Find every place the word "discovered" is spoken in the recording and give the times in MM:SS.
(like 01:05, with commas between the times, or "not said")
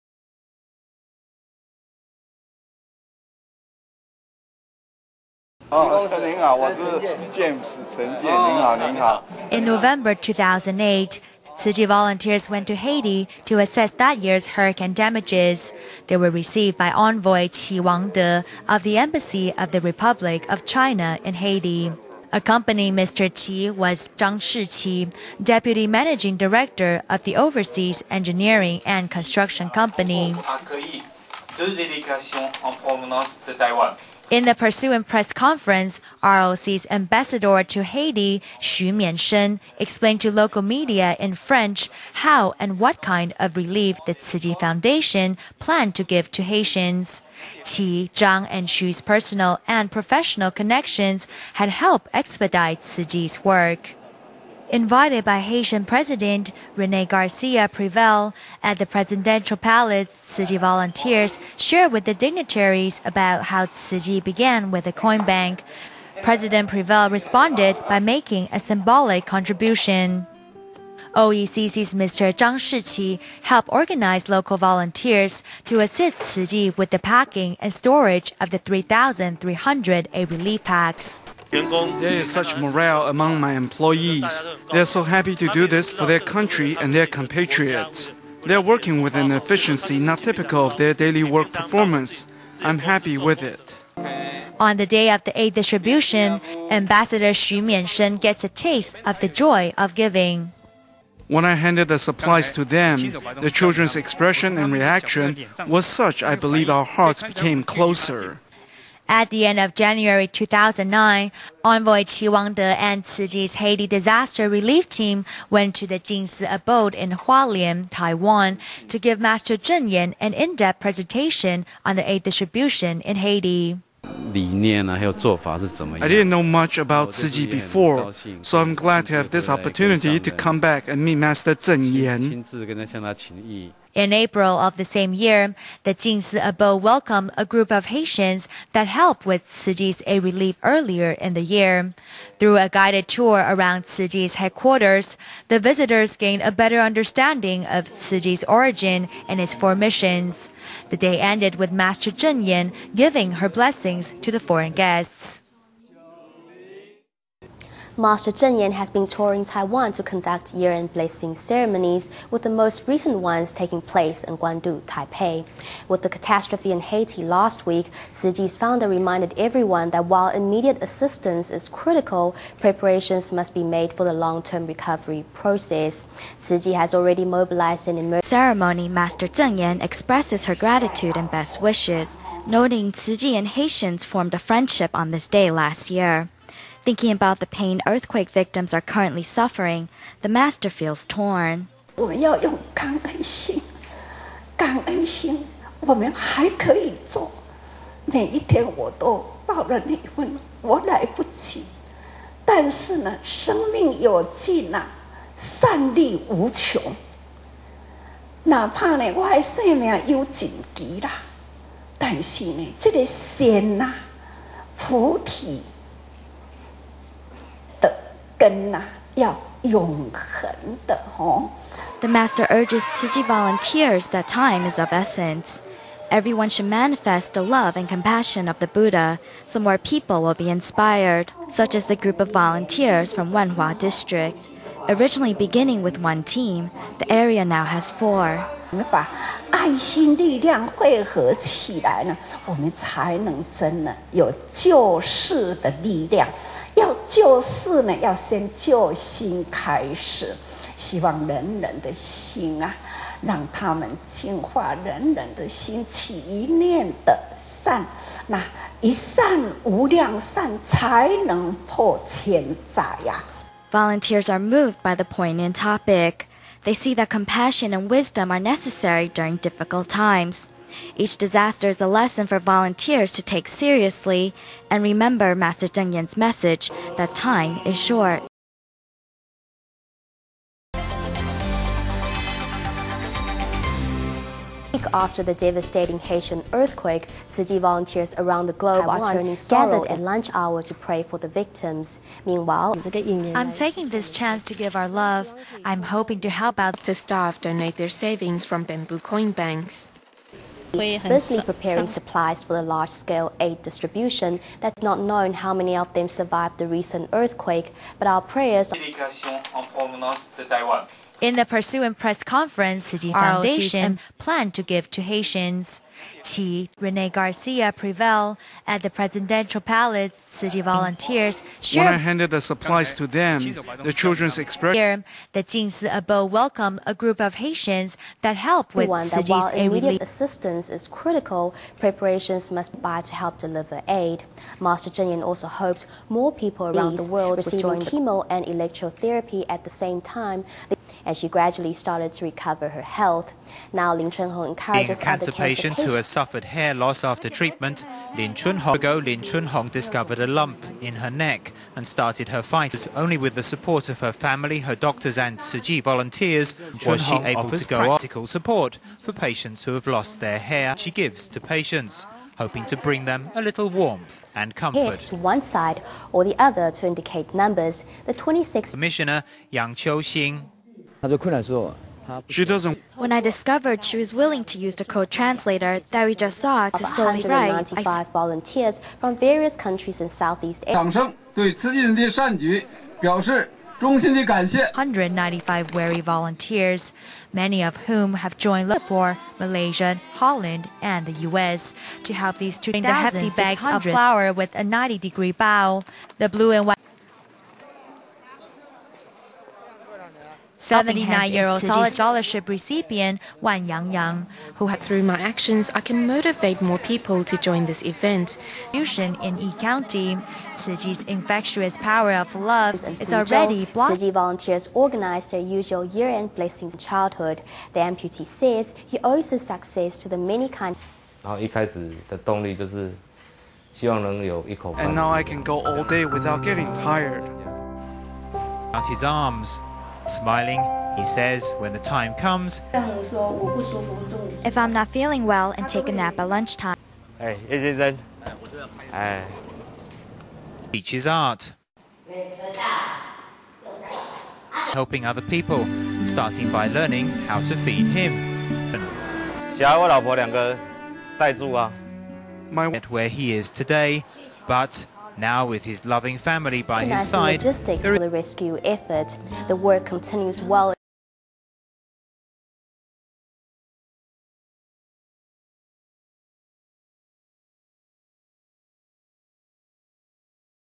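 05:49, 06:13.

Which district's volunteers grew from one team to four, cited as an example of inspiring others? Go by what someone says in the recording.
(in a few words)
Wenhua.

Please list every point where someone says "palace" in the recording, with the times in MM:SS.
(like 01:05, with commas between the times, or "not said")
00:59, 05:19.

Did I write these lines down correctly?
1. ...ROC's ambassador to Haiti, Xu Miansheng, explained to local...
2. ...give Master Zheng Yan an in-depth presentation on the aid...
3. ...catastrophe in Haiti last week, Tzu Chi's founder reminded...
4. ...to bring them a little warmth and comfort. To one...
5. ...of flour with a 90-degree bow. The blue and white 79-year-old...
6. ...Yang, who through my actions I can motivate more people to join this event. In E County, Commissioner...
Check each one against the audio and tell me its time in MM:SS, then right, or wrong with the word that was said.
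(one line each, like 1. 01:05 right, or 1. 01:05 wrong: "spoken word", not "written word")
1. 00:36 right
2. 01:58 right
3. 02:46 right
4. 06:02 right
5. 06:33 right
6. 06:43 wrong: "Tzu", not "Commissioner".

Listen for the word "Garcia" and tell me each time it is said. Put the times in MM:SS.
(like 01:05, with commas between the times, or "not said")
00:57, 05:17.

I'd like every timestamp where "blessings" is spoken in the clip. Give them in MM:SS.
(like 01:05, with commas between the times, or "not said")
02:33, 02:40, 06:56.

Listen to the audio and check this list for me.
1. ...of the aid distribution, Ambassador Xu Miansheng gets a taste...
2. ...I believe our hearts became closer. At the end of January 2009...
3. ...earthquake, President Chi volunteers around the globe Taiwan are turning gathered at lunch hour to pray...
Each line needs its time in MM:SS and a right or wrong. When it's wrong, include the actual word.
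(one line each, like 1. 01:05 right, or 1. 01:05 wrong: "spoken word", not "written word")
1. 01:35 right
2. 01:46 right
3. 04:46 wrong: "Tzu", not "President".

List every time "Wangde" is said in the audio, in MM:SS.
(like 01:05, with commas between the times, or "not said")
00:17, 01:52.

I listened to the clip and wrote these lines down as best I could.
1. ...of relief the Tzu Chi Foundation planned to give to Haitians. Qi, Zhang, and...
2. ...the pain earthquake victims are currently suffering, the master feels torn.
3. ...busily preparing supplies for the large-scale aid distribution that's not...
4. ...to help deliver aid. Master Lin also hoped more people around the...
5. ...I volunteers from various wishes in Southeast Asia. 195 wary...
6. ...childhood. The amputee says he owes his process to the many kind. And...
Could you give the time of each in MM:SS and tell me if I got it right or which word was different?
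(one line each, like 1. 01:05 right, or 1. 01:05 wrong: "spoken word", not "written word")
1. 00:43 right
2. 03:07 right
3. 05:00 right
4. 05:33 wrong: "Jinyan", not "Lin"
5. 06:17 wrong: "countries", not "wishes"
6. 06:56 wrong: "success", not "process".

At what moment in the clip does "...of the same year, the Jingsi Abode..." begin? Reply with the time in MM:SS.
02:14.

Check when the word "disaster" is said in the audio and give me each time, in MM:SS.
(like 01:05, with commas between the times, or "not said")
01:53, 04:31.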